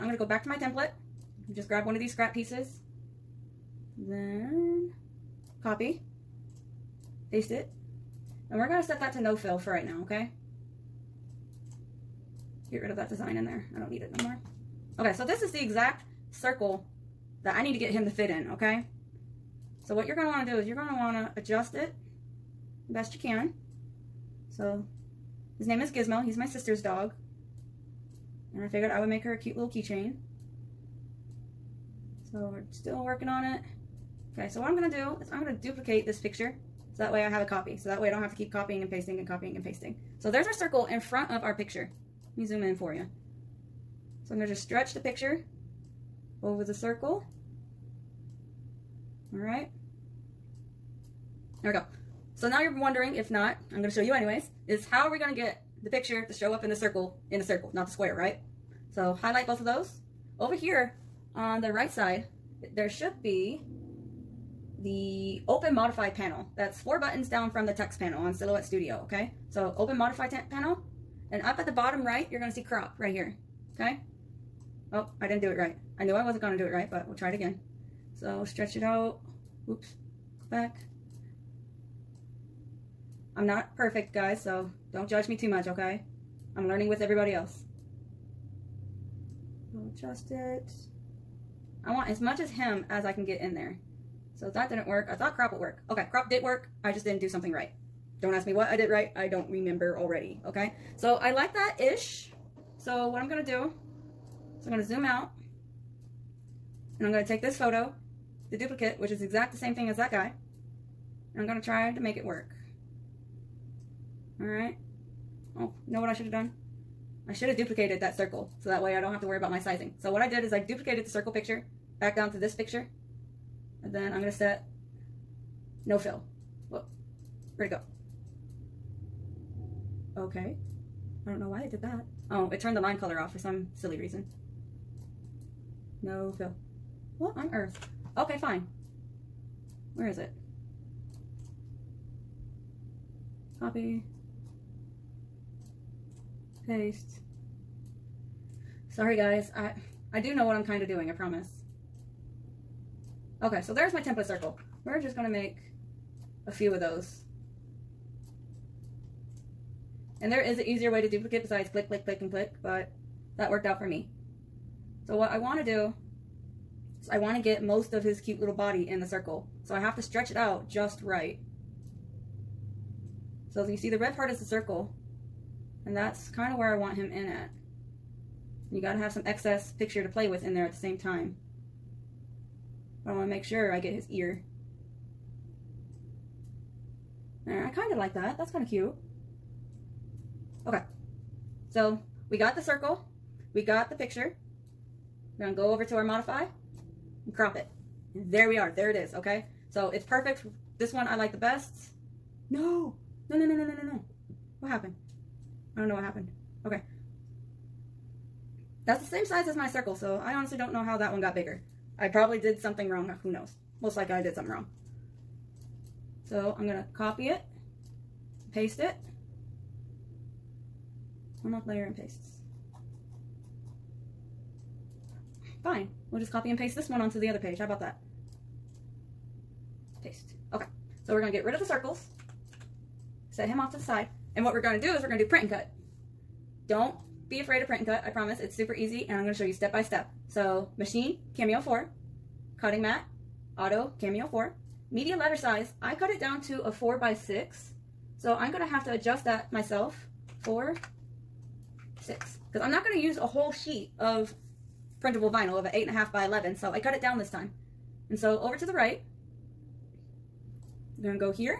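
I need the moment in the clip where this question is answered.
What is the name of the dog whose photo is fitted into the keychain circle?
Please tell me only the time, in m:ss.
0:25.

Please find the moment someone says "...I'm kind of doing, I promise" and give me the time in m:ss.
2:30.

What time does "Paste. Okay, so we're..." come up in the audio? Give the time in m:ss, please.
3:50.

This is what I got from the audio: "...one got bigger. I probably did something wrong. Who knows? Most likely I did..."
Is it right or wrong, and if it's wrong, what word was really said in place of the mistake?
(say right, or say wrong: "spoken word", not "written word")
right.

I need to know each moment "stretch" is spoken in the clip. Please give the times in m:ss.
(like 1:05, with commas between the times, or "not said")
0:44, 1:18, 2:50.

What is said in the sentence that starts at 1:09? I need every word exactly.
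So open modify panel, and up at the bottom right, you're gonna see crop right here, okay?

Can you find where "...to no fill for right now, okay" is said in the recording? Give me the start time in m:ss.
0:09.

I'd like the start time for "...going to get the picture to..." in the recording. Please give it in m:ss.
0:55.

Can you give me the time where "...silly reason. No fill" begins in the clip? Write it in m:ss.
2:13.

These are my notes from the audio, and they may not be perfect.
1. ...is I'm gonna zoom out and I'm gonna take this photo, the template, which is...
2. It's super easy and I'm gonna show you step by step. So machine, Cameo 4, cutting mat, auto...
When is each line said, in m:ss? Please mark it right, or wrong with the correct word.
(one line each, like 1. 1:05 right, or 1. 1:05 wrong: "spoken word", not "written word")
1. 1:44 wrong: "duplicate", not "template"
2. 3:58 right.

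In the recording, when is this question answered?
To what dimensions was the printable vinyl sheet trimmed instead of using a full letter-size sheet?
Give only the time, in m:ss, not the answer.
4:06.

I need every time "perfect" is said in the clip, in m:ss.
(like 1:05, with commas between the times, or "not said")
1:23, 3:20.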